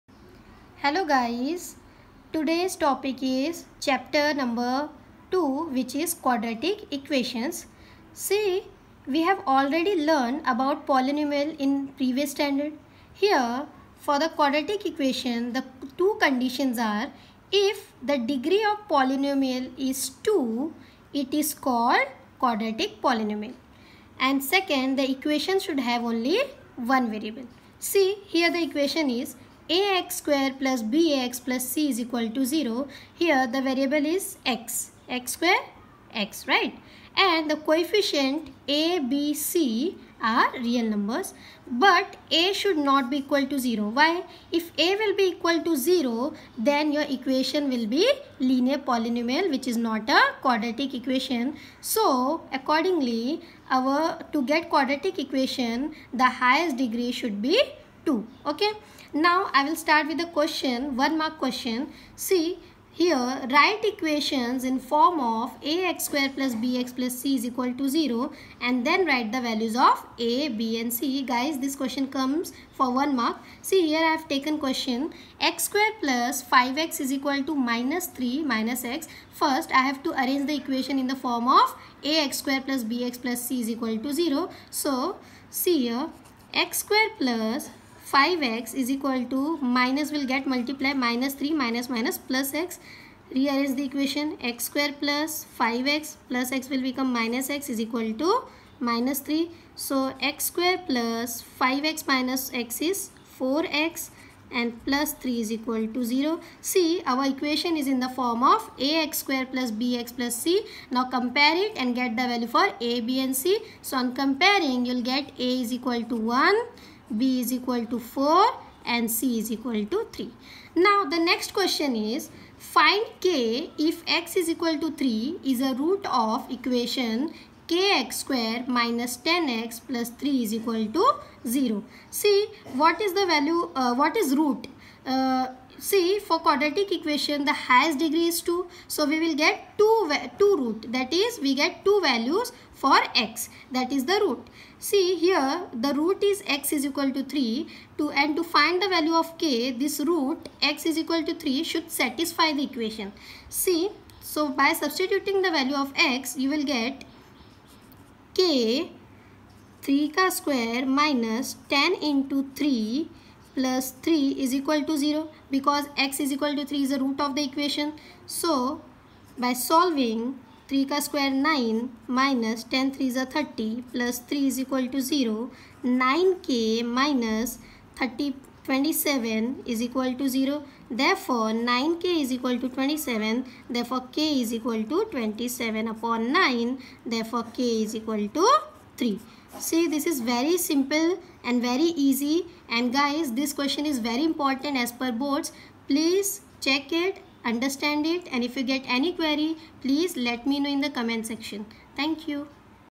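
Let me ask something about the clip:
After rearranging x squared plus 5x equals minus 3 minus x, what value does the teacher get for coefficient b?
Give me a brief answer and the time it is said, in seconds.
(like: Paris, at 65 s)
4, at 117 s.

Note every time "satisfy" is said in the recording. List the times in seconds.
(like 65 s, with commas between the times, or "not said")
151 s.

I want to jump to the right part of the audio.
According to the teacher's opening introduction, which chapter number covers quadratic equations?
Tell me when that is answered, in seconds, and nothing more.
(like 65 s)
3 s.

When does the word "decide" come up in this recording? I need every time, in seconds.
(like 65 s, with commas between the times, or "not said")
not said.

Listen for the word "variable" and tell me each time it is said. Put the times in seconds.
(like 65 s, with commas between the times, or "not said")
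27 s, 33 s.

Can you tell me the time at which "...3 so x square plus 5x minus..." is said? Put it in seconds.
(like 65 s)
99 s.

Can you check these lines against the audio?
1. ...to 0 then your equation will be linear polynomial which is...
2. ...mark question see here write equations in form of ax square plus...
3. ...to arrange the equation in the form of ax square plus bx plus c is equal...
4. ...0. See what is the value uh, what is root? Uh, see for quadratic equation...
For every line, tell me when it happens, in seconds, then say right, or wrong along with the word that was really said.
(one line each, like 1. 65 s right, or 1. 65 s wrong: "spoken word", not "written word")
1. 45 s right
2. 61 s right
3. 80 s right
4. 131 s right.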